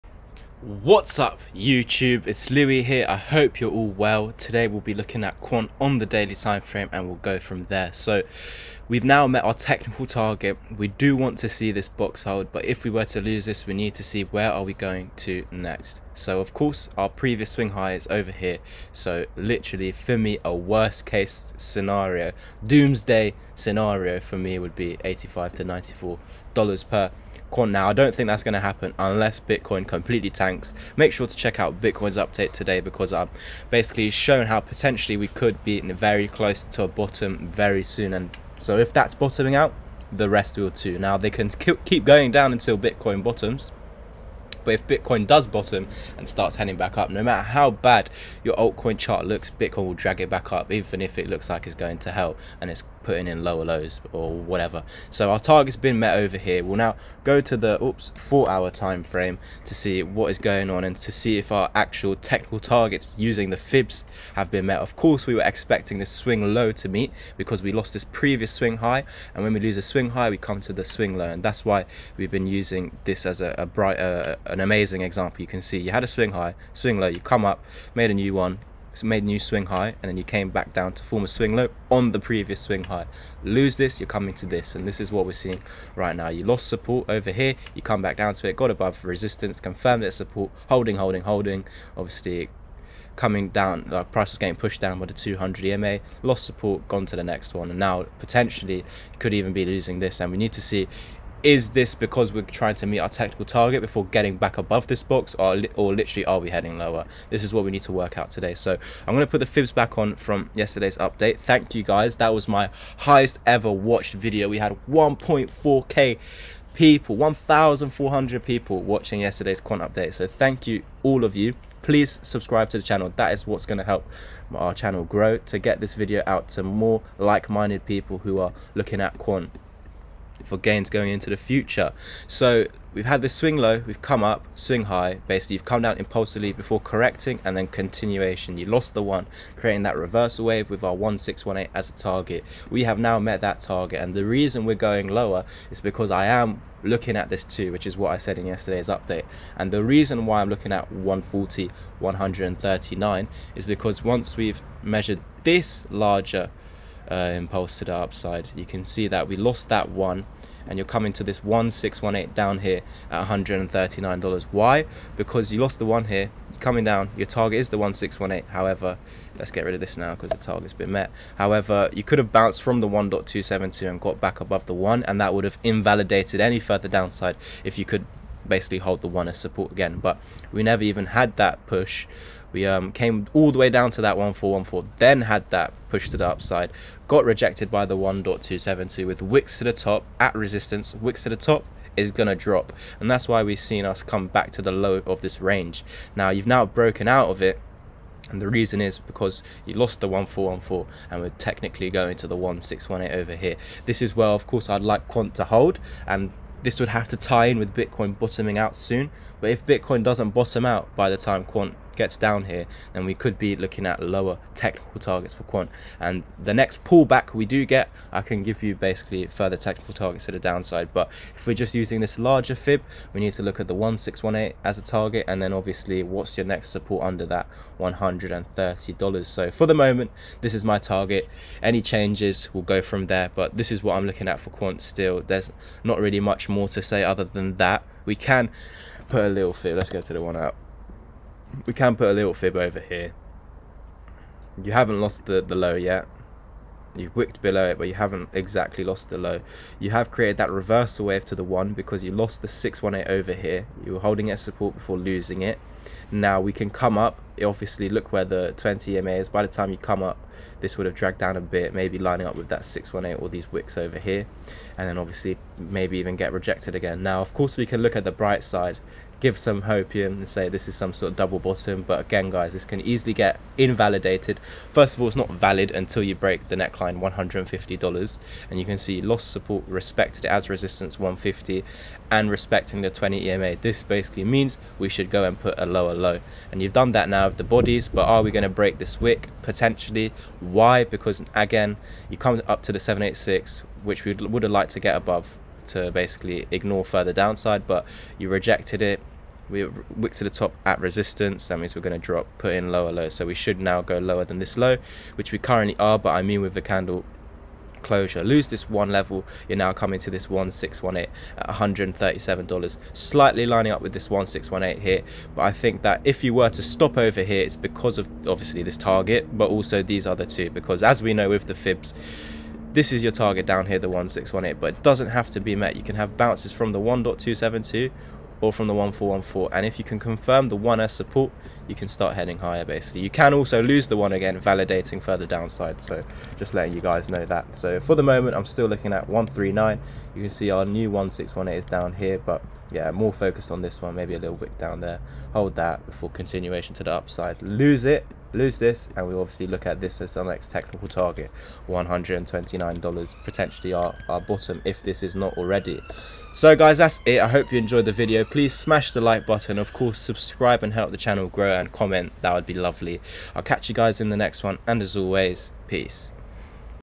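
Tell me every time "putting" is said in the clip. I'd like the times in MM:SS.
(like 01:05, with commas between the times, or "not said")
00:53.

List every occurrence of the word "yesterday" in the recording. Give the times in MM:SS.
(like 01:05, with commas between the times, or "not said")
01:50, 01:59, 02:28.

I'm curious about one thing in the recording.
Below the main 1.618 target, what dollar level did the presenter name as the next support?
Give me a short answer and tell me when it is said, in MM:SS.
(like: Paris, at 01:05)
$130, at 03:47.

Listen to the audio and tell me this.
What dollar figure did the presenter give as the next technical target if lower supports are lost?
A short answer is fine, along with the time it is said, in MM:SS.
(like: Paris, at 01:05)
$129, at 05:51.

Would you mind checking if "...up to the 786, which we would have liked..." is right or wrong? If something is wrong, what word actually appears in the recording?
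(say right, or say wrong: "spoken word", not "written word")
right.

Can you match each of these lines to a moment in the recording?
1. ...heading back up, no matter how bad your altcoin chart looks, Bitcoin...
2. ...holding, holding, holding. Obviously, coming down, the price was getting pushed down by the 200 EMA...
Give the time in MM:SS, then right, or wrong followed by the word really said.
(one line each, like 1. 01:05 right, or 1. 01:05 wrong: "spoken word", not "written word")
1. 00:46 right
2. 01:30 right.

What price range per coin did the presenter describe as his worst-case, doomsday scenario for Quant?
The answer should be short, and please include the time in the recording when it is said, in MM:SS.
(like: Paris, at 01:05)
$85 to $94, at 00:25.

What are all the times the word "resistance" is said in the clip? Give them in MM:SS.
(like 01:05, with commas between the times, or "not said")
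01:29, 03:10, 04:40, 05:00.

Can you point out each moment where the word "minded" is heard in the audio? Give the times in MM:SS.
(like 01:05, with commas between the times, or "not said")
02:07.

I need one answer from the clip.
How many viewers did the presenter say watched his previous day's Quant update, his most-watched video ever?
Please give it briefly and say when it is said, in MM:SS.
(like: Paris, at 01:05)
1400, at 01:57.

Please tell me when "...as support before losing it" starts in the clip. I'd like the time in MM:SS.
04:14.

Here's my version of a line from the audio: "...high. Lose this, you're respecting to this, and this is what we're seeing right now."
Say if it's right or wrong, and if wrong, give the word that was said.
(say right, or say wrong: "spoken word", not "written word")
wrong: "coming", not "respecting".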